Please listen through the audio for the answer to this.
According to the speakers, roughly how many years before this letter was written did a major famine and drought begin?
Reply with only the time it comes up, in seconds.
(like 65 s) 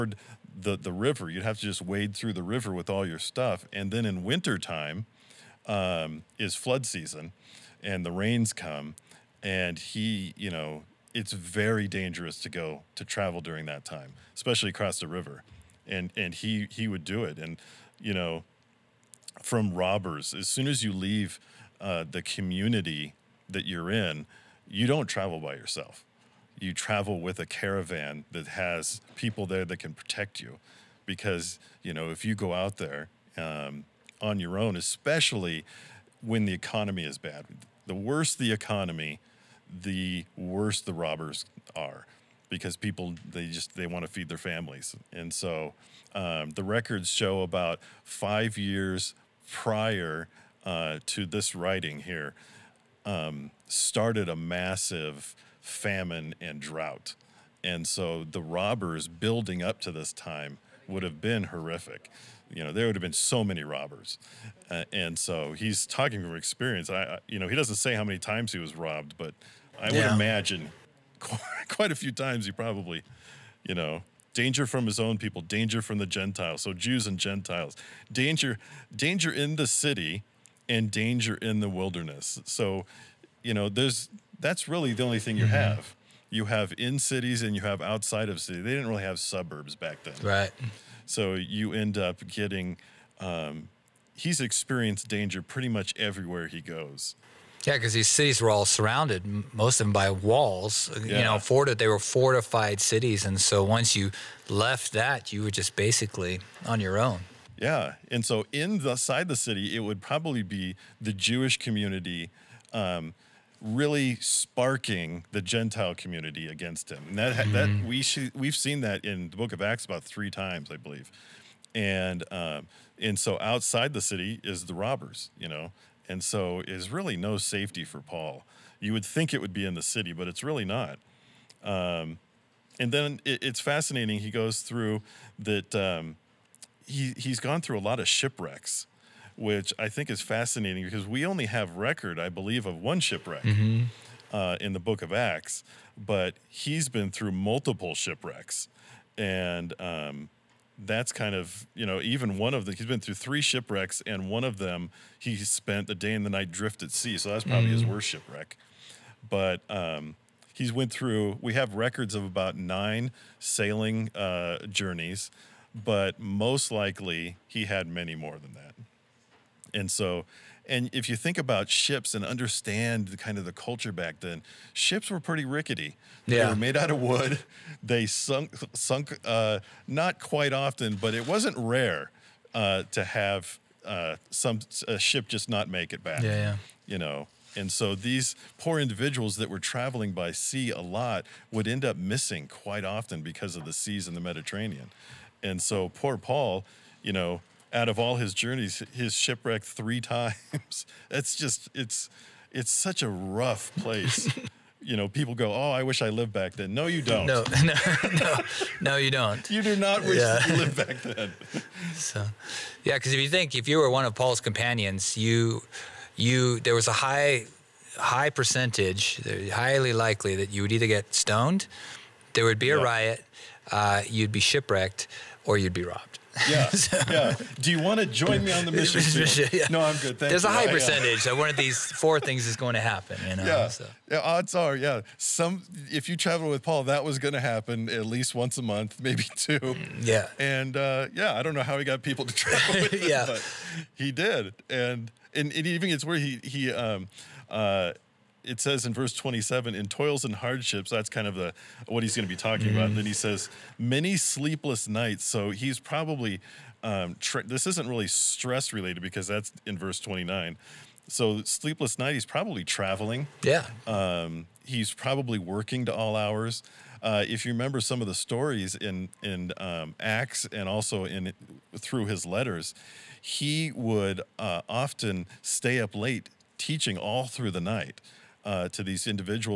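48 s.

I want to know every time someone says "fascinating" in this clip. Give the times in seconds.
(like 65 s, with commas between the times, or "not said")
133 s, 140 s.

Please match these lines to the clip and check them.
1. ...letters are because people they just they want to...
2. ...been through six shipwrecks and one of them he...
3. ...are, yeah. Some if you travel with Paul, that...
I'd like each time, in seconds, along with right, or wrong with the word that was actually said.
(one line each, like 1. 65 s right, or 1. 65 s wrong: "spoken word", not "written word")
1. 40 s wrong: "robbers", not "letters"
2. 152 s wrong: "three", not "six"
3. 234 s right.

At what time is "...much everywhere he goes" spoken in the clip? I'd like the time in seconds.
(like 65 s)
95 s.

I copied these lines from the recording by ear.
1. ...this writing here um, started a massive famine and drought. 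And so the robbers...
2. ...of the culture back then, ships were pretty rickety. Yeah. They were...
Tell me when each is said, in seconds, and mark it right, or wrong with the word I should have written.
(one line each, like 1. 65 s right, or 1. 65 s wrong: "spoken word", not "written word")
1. 51 s right
2. 173 s right.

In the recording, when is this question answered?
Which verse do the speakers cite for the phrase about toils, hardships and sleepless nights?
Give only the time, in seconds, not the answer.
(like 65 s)
248 s.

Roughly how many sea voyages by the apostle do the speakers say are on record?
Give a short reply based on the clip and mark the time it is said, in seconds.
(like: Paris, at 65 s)
9, at 162 s.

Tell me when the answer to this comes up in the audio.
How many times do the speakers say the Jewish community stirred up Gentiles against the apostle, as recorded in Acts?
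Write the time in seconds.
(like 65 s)
120 s.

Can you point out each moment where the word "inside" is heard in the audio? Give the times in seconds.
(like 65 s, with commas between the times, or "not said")
108 s.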